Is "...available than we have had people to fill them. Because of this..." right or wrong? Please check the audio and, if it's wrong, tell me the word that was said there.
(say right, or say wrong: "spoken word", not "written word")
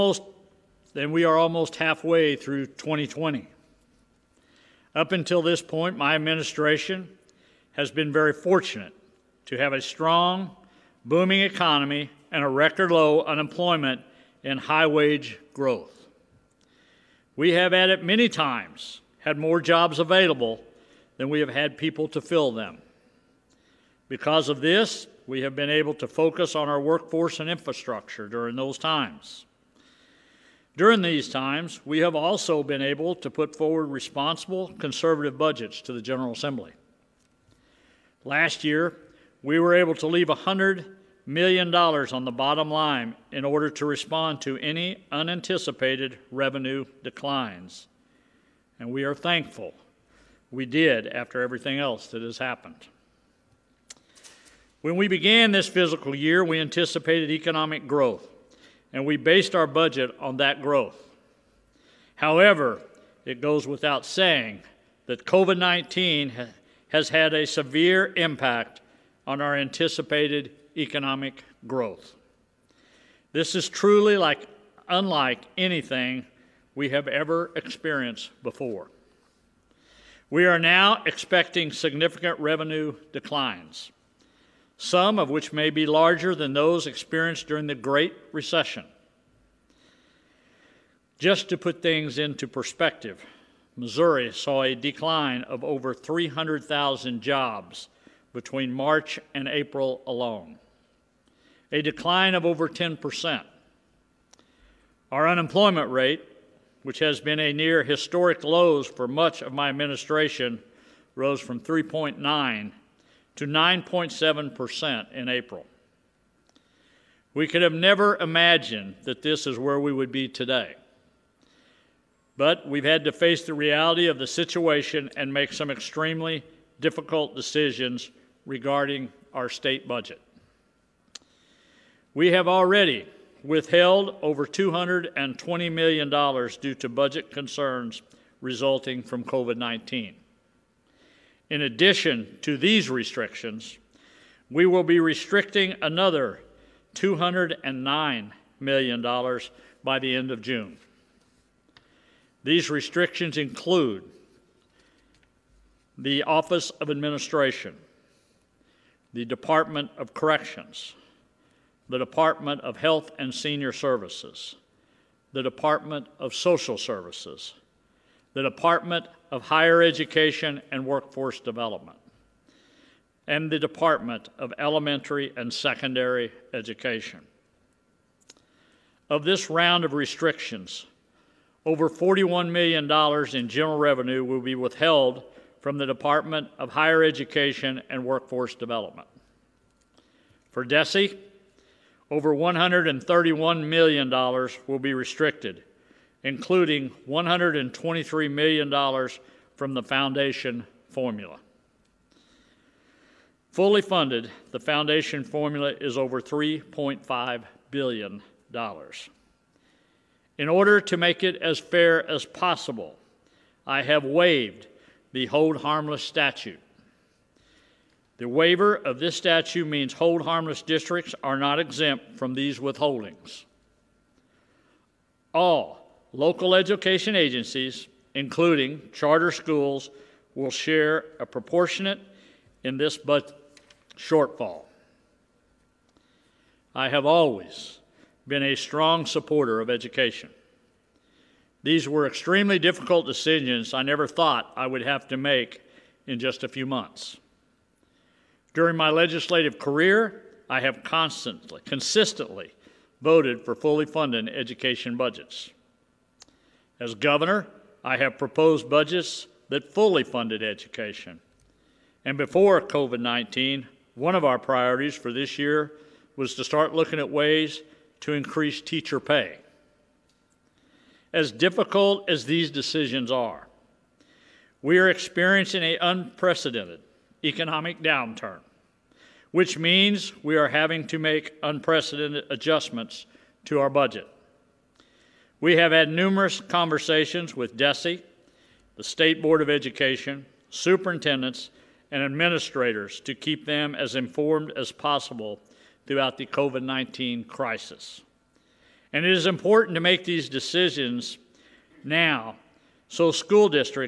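right.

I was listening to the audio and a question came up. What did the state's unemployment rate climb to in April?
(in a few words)
9.7%.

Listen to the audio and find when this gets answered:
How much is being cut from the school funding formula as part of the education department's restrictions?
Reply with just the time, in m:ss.
3:17.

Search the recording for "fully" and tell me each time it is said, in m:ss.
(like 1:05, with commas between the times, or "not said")
3:23, 4:13, 4:19.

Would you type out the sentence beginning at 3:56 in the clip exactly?
I have always been a strong supporter of education.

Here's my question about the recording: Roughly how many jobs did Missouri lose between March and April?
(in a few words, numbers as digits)
300,000.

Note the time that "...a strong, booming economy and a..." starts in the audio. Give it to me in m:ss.
0:09.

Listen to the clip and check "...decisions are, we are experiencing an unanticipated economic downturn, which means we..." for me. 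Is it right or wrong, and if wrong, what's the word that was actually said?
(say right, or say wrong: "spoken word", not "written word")
wrong: "unprecedented", not "unanticipated".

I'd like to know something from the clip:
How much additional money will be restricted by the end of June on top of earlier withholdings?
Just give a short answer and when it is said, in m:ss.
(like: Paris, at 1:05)
$209 million, at 2:26.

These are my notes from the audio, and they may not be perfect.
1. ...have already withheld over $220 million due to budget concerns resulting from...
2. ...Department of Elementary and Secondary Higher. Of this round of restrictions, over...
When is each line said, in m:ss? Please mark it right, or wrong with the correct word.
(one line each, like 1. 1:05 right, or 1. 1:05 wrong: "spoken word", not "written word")
1. 2:12 right
2. 2:53 wrong: "Education", not "Higher".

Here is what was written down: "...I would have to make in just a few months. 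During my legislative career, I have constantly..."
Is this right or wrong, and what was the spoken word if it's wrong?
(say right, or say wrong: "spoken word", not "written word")
right.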